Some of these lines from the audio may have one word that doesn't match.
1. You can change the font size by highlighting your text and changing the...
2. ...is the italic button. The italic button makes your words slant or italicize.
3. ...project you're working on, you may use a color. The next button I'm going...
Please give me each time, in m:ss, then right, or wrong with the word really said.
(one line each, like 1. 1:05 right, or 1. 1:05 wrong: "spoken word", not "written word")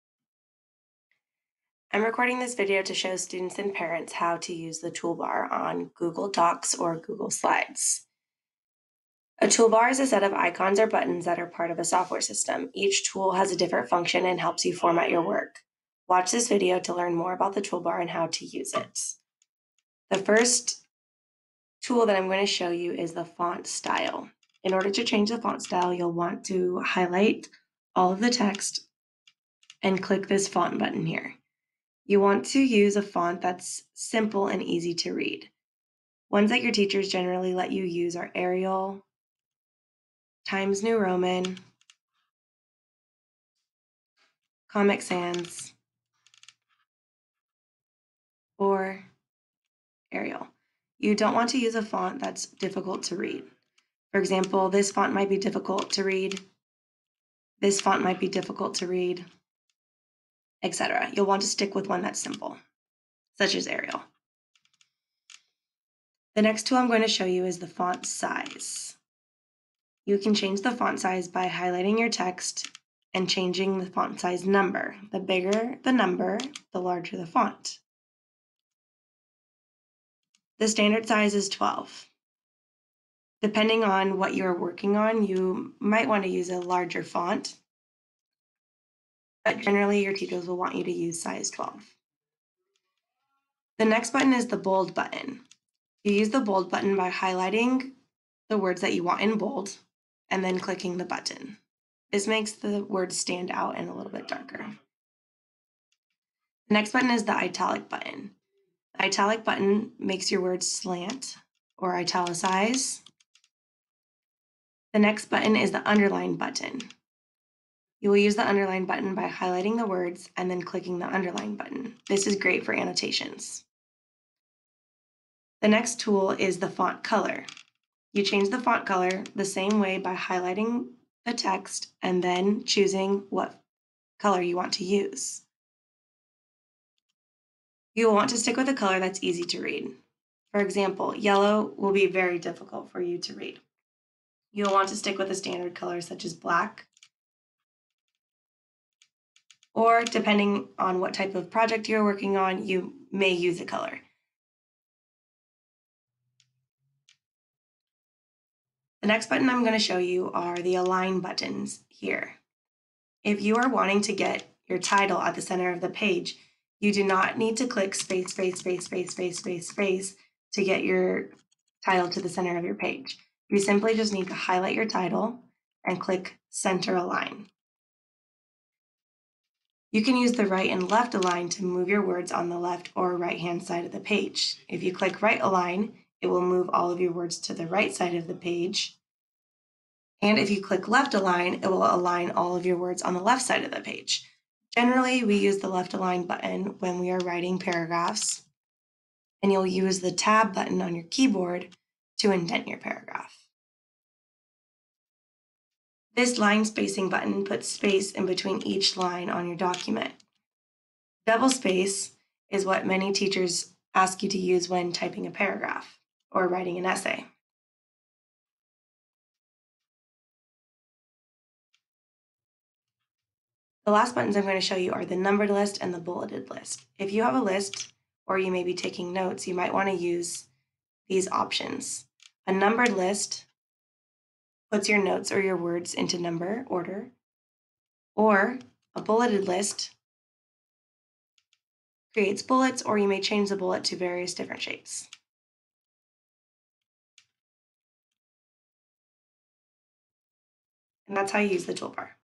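1. 1:10 right
2. 1:47 right
3. 2:31 right.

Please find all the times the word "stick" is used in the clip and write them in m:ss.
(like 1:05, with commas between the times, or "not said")
1:01, 2:18, 2:24.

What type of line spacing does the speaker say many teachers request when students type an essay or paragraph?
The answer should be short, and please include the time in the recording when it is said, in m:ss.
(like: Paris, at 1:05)
Double space, at 3:31.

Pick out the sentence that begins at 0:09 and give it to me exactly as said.
A toolbar is a set of icons or buttons that are part of a software system.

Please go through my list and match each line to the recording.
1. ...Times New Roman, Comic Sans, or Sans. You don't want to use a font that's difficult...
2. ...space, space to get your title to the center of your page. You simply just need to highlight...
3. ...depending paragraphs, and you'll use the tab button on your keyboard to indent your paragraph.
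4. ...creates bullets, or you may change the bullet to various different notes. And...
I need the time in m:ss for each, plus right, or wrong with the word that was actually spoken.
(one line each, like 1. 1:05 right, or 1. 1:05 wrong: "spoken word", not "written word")
1. 0:40 wrong: "Arial", not "Sans"
2. 2:49 right
3. 3:17 wrong: "writing", not "depending"
4. 4:02 wrong: "shapes", not "notes".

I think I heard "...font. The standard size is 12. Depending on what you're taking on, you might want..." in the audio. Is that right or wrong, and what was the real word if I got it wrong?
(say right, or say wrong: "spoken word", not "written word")
wrong: "working", not "taking".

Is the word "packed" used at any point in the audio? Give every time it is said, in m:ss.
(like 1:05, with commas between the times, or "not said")
not said.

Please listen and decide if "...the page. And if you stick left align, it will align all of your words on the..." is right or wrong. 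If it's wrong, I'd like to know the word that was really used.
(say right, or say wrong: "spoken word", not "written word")
wrong: "click", not "stick".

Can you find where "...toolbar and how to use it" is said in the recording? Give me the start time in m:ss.
0:17.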